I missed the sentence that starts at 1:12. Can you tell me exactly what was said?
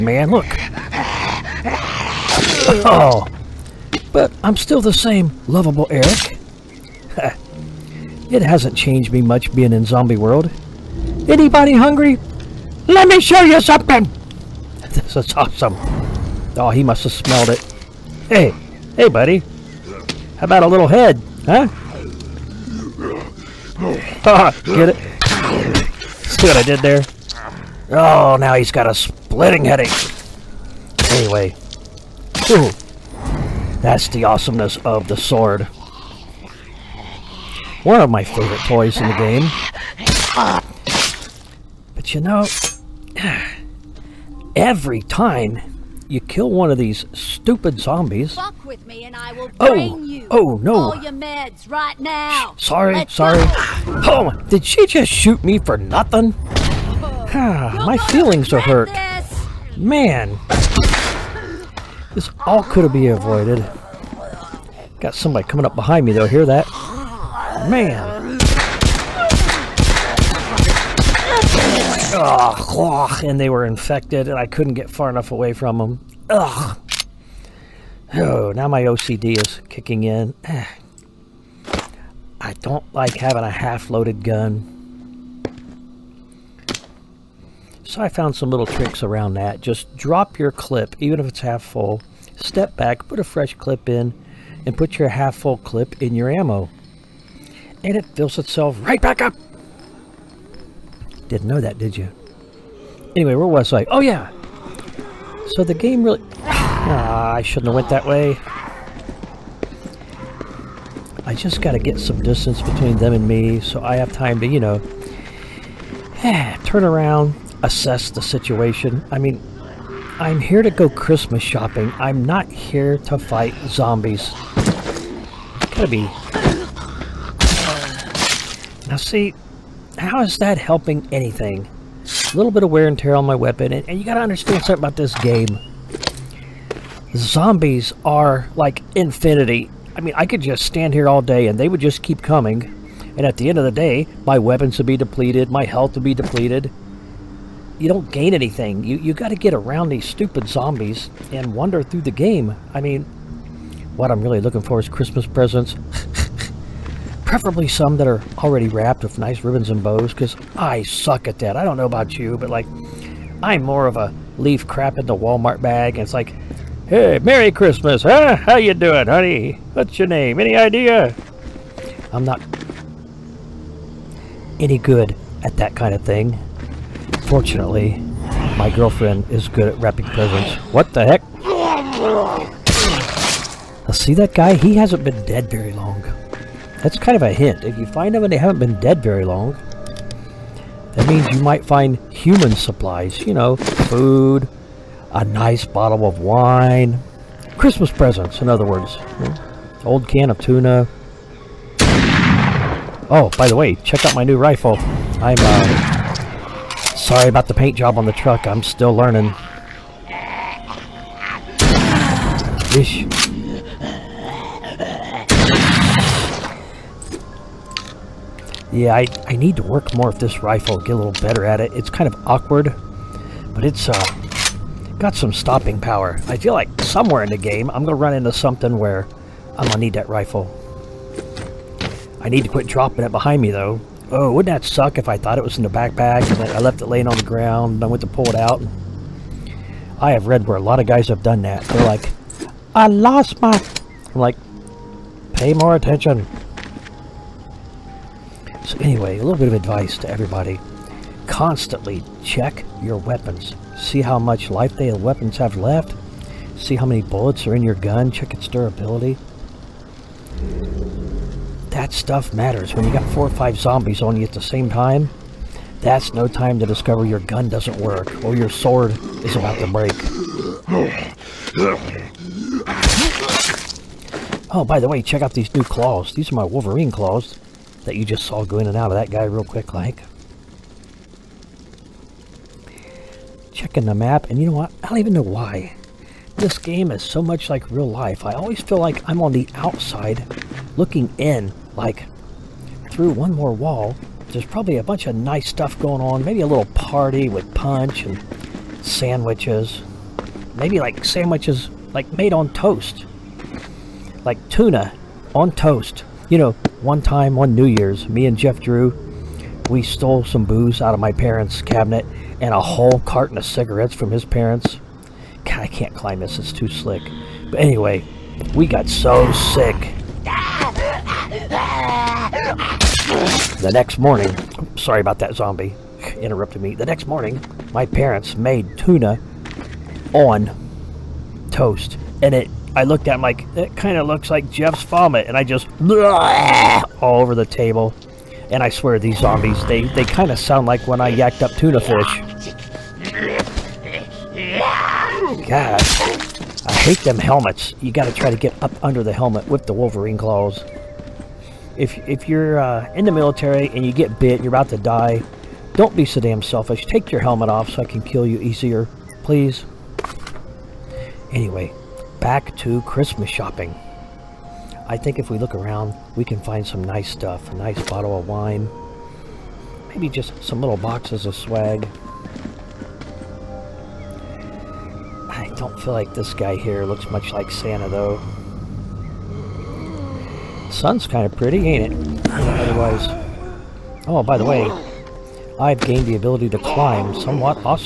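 Ugh, and they were infected and I couldn't get far enough away from them.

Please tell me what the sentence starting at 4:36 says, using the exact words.
These are my Wolverine claws that you just saw go in and out of that guy real quick like.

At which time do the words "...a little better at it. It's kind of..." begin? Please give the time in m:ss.
3:40.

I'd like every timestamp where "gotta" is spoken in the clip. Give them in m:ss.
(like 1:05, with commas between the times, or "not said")
2:05, 2:14.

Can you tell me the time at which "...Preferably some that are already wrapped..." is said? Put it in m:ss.
2:37.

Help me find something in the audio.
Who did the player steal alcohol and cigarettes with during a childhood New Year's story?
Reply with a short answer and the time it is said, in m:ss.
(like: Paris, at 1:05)
Jeff Drew, at 5:08.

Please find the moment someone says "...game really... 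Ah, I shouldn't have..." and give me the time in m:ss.
1:45.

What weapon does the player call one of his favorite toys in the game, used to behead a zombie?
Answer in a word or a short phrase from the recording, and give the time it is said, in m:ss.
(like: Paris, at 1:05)
the sword, at 0:35.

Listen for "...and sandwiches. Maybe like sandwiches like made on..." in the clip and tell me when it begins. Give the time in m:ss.
4:58.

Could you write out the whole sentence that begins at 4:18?
Check its durability that stuff matters.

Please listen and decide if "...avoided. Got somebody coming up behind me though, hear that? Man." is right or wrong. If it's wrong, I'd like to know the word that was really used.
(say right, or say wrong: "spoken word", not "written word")
right.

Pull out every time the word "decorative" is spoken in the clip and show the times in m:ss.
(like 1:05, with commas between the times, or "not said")
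not said.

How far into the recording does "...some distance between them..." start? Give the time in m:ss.
1:52.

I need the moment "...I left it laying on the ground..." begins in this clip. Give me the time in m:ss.
3:56.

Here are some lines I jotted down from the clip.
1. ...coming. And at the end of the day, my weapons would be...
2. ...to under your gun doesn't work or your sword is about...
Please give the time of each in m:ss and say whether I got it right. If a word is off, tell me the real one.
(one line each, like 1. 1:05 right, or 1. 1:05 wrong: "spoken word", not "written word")
1. 2:22 right
2. 4:26 wrong: "discover", not "under".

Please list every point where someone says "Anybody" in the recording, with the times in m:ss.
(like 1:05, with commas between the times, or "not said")
0:11.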